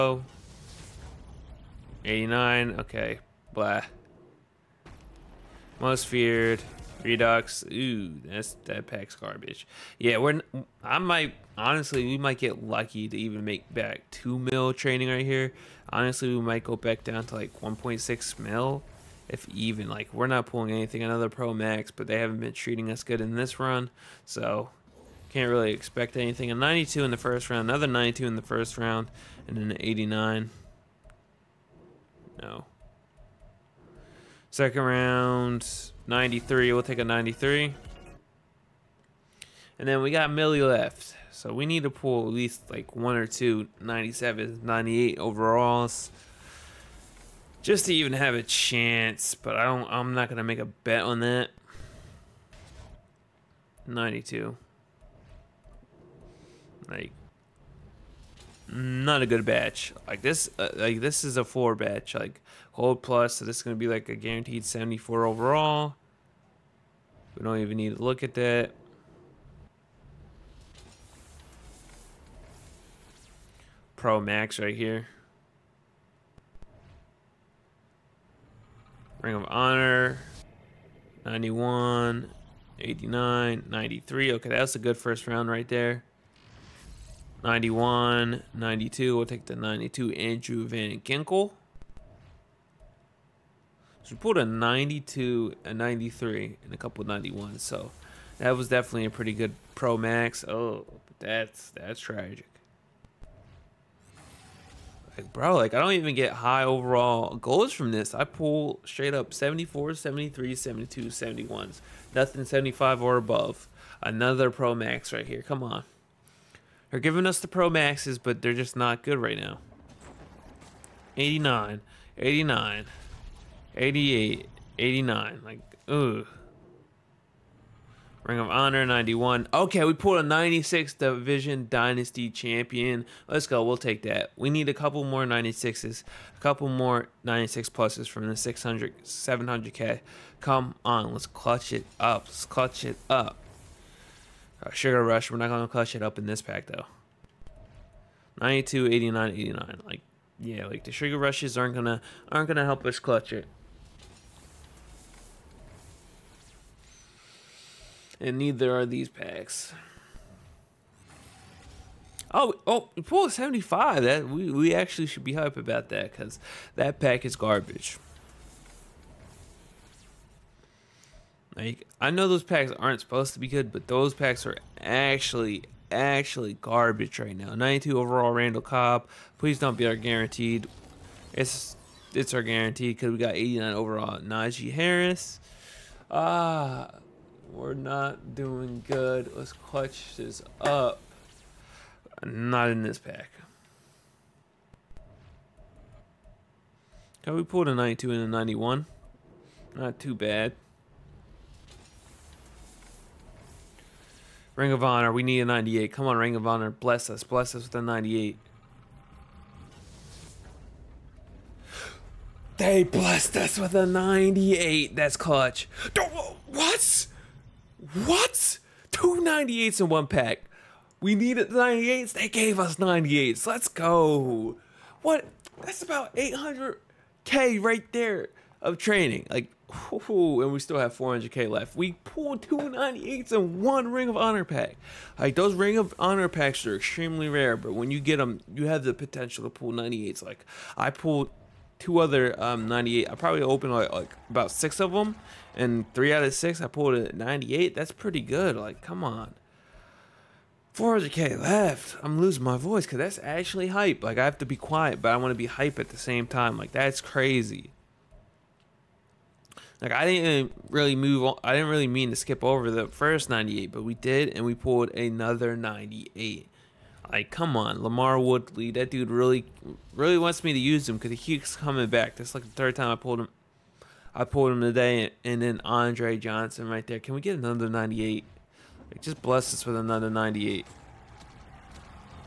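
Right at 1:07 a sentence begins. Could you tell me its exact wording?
We don't even need to look at that.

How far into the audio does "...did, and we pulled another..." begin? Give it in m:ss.
4:23.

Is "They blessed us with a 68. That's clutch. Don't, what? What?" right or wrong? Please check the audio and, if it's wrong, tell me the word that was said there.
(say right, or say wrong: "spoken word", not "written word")
wrong: "98", not "68".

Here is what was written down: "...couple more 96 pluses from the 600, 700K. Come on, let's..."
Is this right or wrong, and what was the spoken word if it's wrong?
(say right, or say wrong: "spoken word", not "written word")
right.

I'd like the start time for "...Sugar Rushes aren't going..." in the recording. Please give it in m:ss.
2:30.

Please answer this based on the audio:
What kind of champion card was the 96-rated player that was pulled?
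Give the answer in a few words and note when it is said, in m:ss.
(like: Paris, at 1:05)
Division Dynasty Champion, at 2:10.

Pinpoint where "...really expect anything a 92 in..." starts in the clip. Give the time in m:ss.
0:25.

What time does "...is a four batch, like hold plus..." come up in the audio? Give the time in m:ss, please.
1:01.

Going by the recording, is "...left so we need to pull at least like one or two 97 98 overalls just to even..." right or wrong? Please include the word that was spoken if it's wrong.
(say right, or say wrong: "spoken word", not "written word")
right.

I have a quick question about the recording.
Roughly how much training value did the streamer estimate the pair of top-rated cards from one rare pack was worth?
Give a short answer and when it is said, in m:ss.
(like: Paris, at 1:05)
800k, at 3:46.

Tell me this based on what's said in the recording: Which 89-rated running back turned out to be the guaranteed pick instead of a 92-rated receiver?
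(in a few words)
Najee Harris.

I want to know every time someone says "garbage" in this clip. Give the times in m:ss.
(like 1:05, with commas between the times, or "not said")
0:09, 2:47, 2:56.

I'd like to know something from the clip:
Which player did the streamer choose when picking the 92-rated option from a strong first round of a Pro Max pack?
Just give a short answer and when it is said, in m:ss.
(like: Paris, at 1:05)
Andrew Van Ginkel, at 1:30.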